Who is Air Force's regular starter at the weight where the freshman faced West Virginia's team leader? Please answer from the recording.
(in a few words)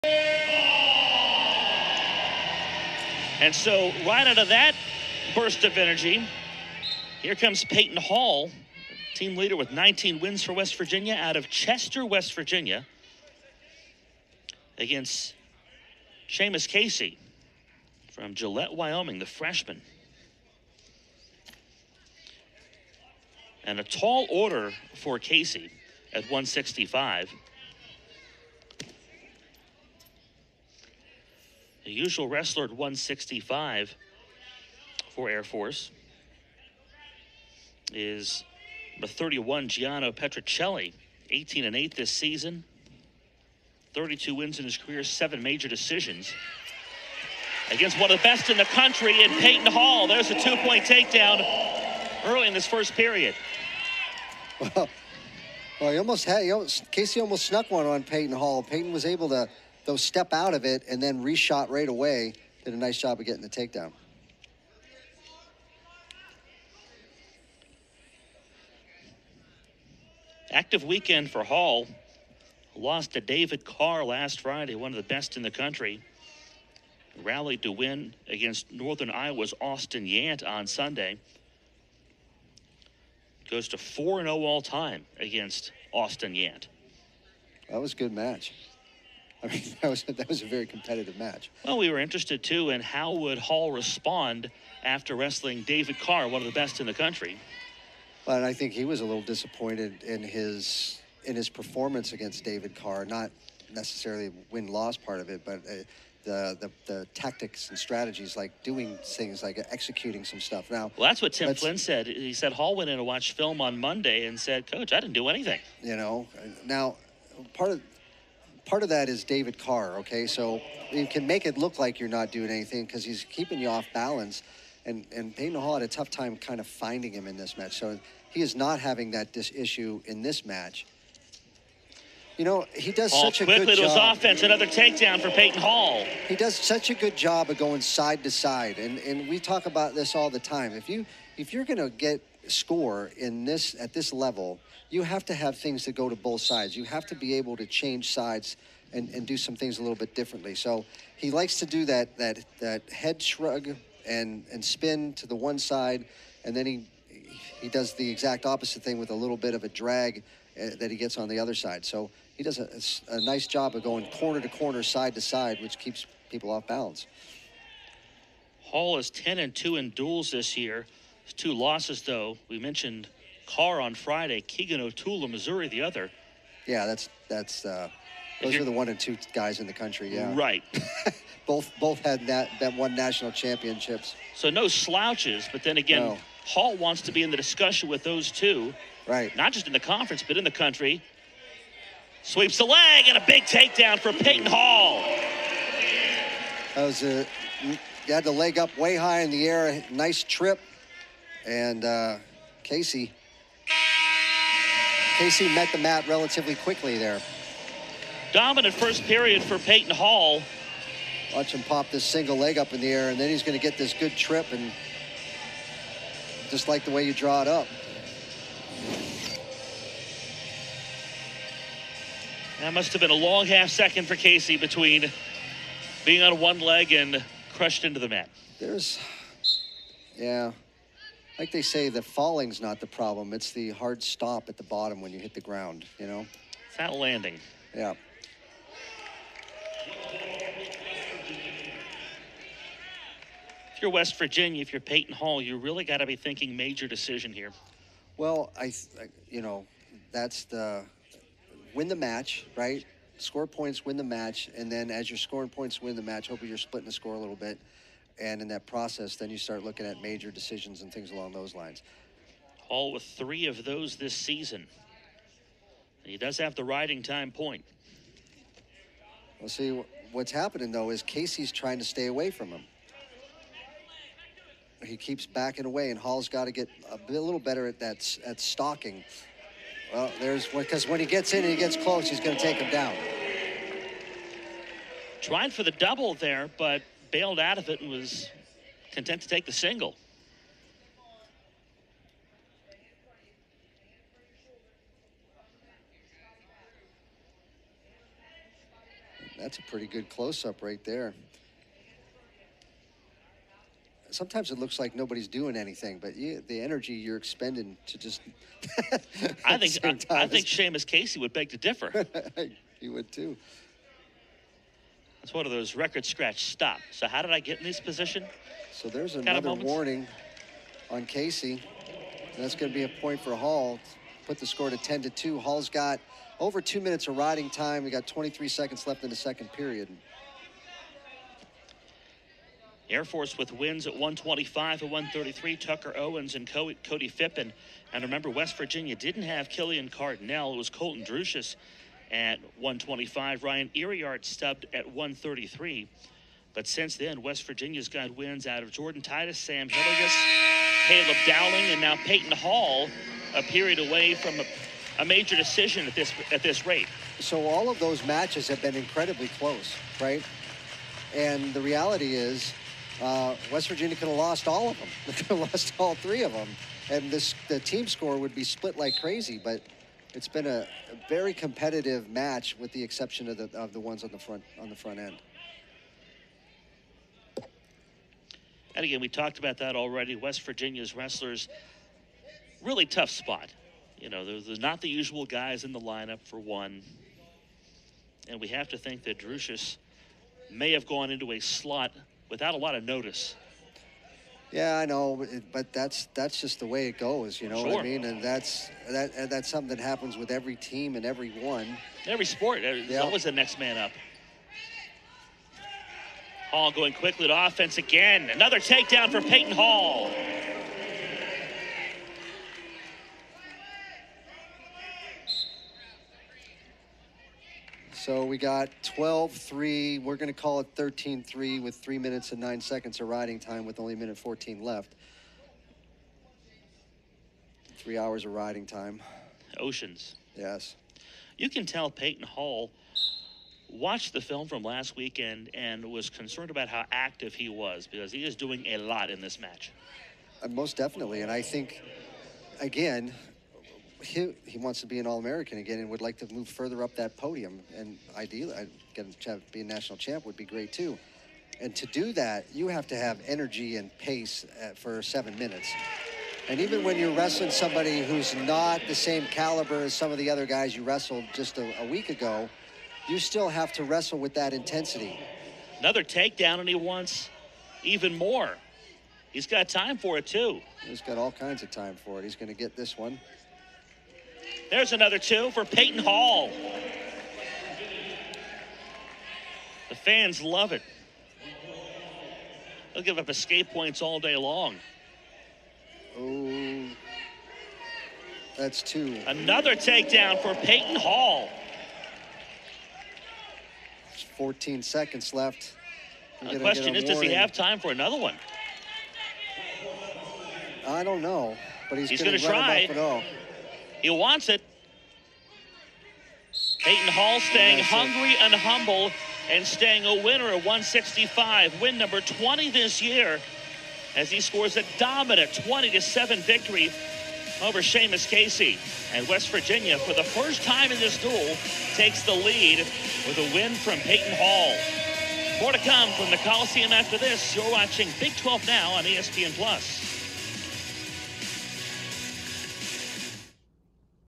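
Gianno Petricelli.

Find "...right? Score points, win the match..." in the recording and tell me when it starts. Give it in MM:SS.
04:12.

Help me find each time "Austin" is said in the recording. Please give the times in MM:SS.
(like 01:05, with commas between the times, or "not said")
01:19, 01:25.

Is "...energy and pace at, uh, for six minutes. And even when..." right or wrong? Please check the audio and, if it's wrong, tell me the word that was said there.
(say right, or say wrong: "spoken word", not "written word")
wrong: "seven", not "six".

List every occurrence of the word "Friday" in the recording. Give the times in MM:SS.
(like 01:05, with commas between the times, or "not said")
01:14, 02:53.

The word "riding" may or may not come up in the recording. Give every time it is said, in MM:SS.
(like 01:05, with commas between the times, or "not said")
04:26, 05:27, 07:03, 07:08.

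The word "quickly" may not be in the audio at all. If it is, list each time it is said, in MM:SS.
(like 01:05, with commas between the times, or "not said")
02:13, 03:26, 06:46.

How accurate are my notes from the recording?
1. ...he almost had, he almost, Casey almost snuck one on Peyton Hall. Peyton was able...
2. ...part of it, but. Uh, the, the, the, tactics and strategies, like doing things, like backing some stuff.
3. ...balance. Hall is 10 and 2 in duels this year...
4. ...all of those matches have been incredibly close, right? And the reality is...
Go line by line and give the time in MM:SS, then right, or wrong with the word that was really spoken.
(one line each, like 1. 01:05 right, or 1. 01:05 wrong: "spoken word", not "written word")
1. 00:55 right
2. 01:44 wrong: "executing", not "backing"
3. 02:46 right
4. 05:57 right.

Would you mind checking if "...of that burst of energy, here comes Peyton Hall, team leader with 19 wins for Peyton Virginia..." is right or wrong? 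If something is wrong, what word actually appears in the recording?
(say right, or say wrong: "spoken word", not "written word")
wrong: "West", not "Peyton".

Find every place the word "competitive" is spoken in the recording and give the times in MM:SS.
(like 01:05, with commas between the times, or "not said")
01:30, 06:11.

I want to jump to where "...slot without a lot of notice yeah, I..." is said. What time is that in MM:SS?
06:31.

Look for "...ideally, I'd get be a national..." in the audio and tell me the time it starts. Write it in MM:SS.
07:28.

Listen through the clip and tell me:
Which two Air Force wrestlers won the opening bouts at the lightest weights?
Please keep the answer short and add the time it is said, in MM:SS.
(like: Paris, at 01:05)
Tucker Owens and Cody Phippen, at 05:35.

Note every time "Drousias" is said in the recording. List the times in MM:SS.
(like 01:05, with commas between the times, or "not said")
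05:41, 06:29.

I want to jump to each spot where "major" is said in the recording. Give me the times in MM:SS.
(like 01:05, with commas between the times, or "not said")
00:45, 04:06, 04:20, 05:55.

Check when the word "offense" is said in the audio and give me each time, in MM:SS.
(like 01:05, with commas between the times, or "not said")
02:14, 06:47.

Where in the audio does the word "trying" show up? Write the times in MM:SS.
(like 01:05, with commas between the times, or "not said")
04:31, 04:45.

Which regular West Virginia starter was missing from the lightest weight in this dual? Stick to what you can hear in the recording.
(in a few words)
Killian Cardinale.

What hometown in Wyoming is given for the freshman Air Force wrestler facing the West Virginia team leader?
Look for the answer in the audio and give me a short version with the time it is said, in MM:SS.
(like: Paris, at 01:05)
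Gillette, Wyoming, at 00:18.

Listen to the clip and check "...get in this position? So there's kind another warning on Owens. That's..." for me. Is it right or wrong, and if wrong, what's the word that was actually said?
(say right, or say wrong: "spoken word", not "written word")
wrong: "Casey", not "Owens".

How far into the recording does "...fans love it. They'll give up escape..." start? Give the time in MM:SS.
07:59.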